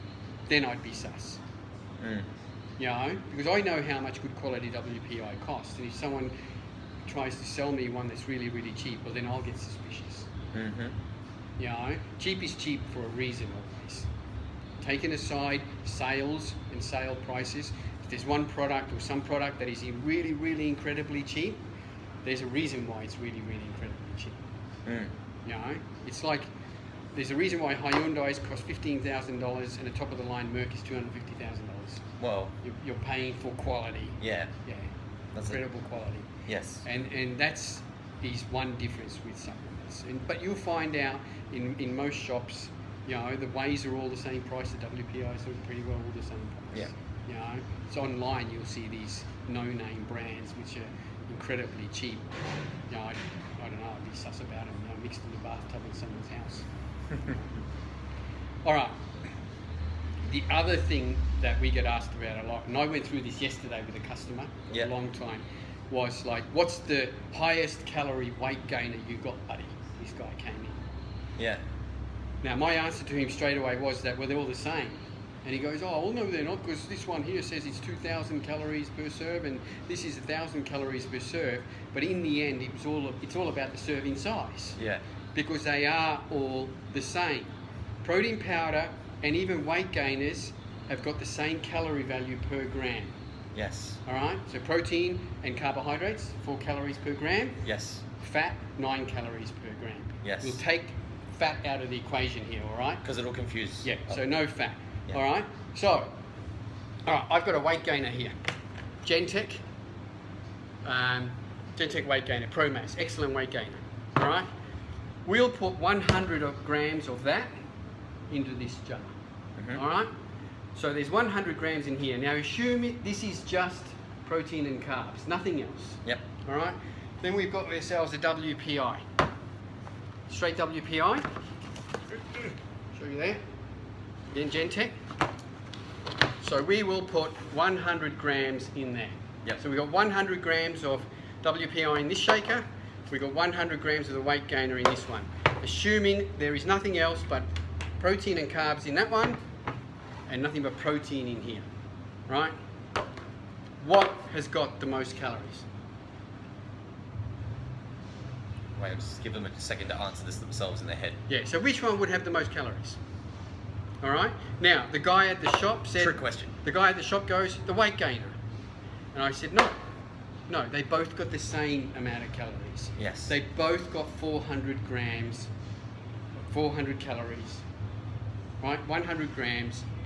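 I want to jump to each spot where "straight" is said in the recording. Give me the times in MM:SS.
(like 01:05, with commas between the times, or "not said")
01:13, 02:10.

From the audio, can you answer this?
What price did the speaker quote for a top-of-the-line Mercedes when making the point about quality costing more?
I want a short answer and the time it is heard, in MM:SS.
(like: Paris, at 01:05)
$250,000, at 00:30.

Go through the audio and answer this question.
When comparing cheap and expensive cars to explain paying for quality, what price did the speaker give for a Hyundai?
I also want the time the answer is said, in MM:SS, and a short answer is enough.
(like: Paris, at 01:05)
$15,000, at 00:28.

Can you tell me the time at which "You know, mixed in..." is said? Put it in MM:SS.
00:54.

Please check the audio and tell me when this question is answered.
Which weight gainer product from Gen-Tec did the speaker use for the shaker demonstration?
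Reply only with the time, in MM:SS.
01:52.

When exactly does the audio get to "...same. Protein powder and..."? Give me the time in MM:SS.
01:27.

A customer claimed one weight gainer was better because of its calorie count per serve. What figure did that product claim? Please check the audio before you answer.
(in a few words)
2,000 calories.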